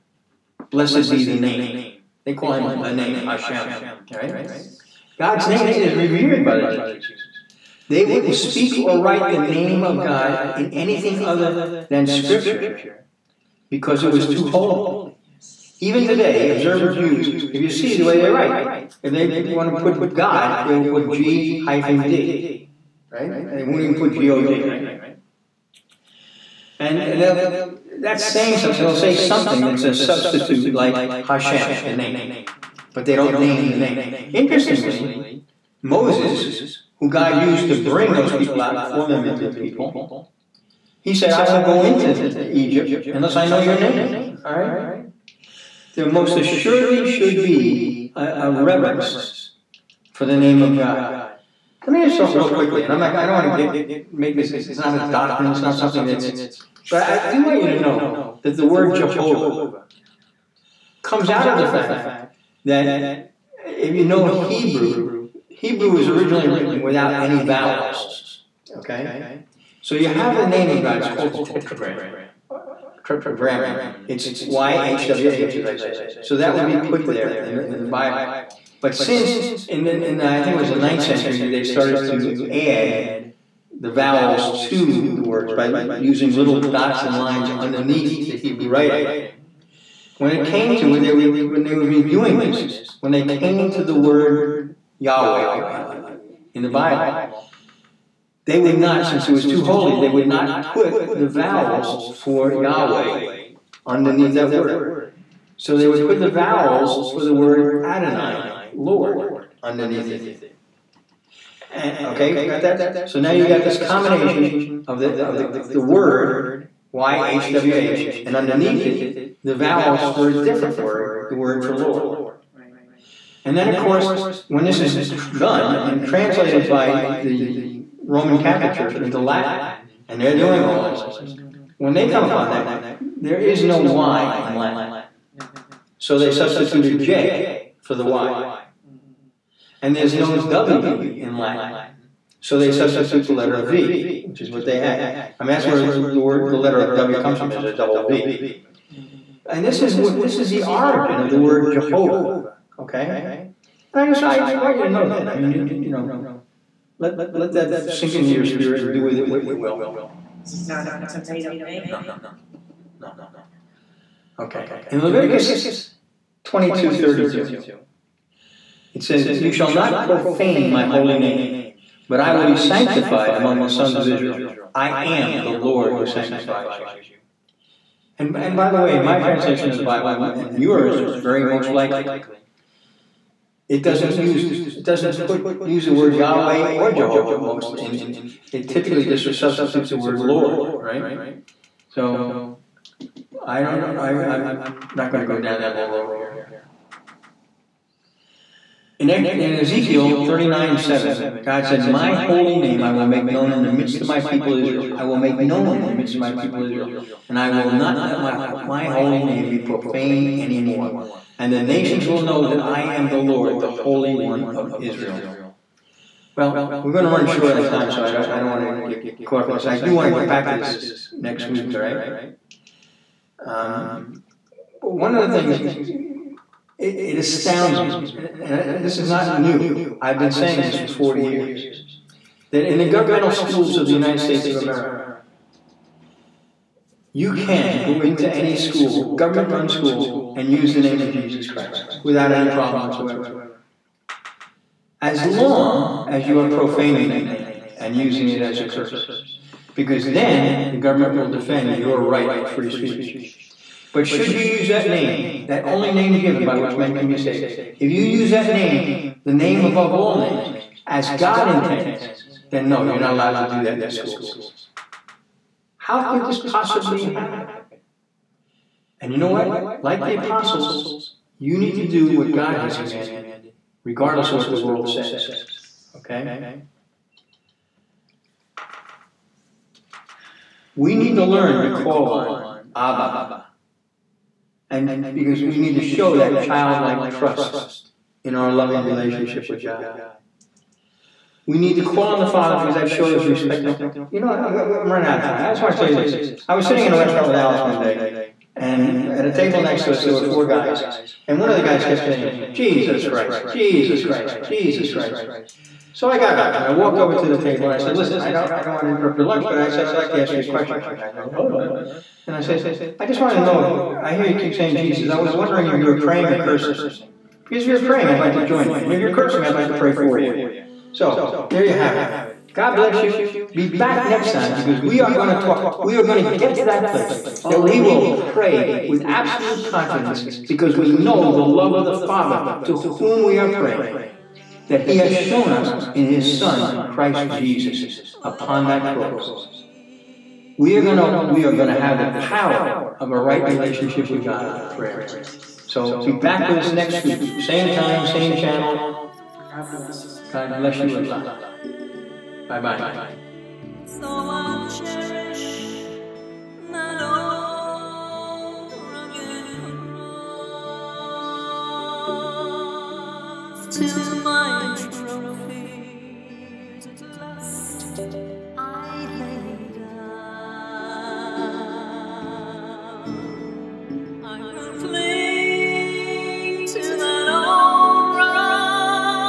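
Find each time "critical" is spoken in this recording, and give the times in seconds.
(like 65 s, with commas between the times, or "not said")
not said.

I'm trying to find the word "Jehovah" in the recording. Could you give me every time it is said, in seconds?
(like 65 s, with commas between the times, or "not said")
58 s, 151 s, 186 s.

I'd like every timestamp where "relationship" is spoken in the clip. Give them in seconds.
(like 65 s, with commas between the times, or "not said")
288 s, 343 s.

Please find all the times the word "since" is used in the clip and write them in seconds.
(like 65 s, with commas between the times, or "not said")
78 s, 99 s.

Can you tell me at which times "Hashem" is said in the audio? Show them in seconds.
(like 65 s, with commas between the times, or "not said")
3 s, 31 s.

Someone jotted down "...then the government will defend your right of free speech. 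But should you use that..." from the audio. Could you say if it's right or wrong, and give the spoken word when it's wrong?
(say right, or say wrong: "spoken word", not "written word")
right.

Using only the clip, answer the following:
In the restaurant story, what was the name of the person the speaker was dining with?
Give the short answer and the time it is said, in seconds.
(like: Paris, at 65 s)
Alice, at 297 s.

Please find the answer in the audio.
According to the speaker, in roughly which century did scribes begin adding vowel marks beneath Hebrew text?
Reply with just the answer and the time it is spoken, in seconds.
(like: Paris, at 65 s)
9th century, at 80 s.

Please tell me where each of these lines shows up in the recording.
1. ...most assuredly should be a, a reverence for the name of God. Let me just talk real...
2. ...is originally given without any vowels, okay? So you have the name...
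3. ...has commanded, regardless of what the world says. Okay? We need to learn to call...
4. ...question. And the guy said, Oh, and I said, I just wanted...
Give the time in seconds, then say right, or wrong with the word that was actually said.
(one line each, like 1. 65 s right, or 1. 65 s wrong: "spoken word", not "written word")
1. 46 s right
2. 65 s wrong: "written", not "given"
3. 272 s right
4. 310 s right.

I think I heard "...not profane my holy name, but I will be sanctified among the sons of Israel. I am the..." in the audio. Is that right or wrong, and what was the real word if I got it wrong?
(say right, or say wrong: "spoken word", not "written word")
right.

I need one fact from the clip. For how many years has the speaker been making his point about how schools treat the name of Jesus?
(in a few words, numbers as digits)
40.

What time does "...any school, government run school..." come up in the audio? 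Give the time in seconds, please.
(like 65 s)
238 s.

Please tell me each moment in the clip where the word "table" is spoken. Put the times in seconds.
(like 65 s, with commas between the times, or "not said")
299 s, 307 s.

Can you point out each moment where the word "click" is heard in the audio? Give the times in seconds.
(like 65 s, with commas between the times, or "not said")
not said.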